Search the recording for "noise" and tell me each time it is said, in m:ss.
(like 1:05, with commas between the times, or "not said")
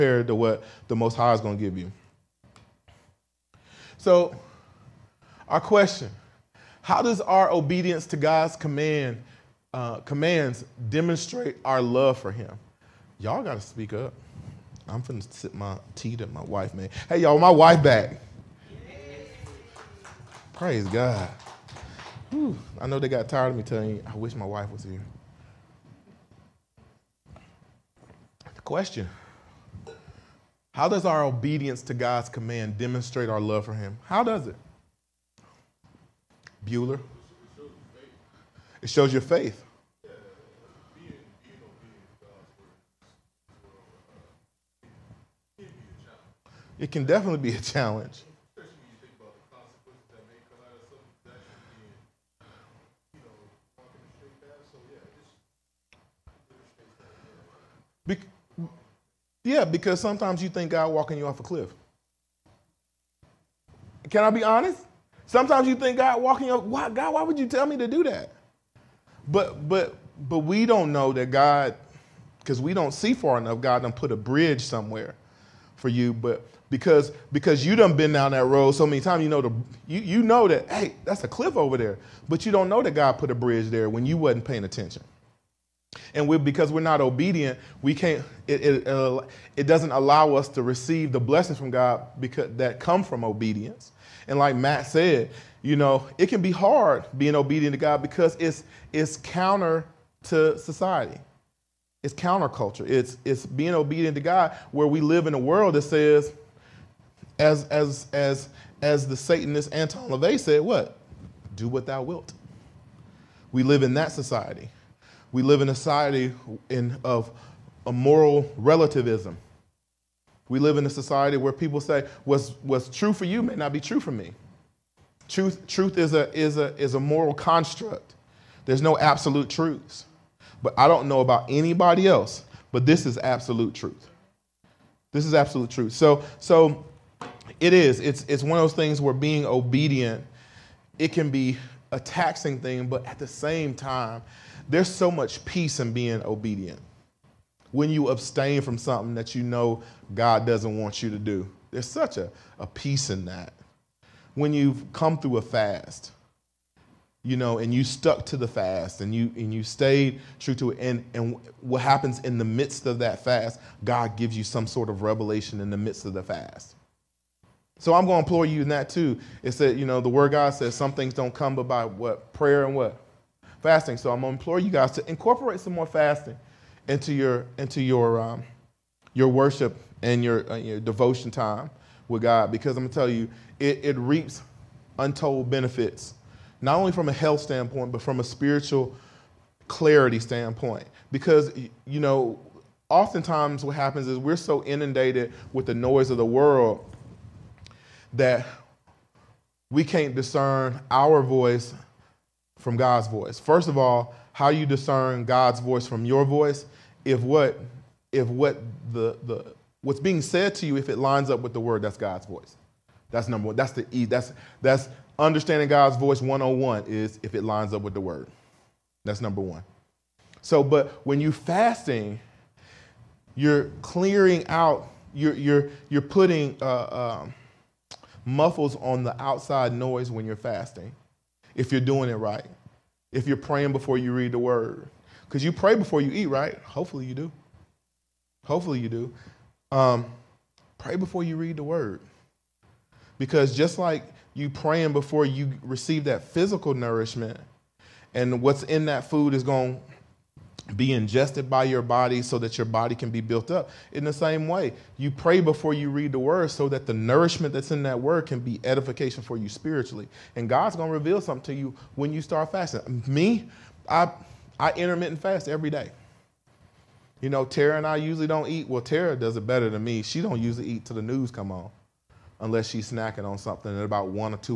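3:15, 3:49.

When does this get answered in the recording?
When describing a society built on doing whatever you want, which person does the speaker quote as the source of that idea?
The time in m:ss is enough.
1:49.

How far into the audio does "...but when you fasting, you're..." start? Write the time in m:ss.
3:40.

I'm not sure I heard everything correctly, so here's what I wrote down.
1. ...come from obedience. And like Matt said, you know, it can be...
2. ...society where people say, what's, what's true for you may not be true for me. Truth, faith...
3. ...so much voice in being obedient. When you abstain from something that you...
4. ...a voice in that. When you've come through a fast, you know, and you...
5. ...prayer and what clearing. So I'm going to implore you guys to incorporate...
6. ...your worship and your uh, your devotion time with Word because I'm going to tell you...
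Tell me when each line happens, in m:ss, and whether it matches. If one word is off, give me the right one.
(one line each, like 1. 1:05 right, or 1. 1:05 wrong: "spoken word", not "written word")
1. 1:32 right
2. 2:00 wrong: "truth", not "faith"
3. 2:24 wrong: "peace", not "voice"
4. 2:32 wrong: "peace", not "voice"
5. 2:52 wrong: "fasting", not "clearing"
6. 2:59 wrong: "God", not "Word".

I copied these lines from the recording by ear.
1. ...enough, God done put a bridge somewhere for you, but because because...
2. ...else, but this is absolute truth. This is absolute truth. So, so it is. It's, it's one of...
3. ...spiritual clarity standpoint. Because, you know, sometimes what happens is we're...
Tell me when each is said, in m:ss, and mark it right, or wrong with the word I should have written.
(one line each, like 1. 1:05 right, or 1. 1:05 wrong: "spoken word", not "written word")
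1. 1:13 right
2. 2:12 right
3. 3:08 wrong: "oftentimes", not "sometimes".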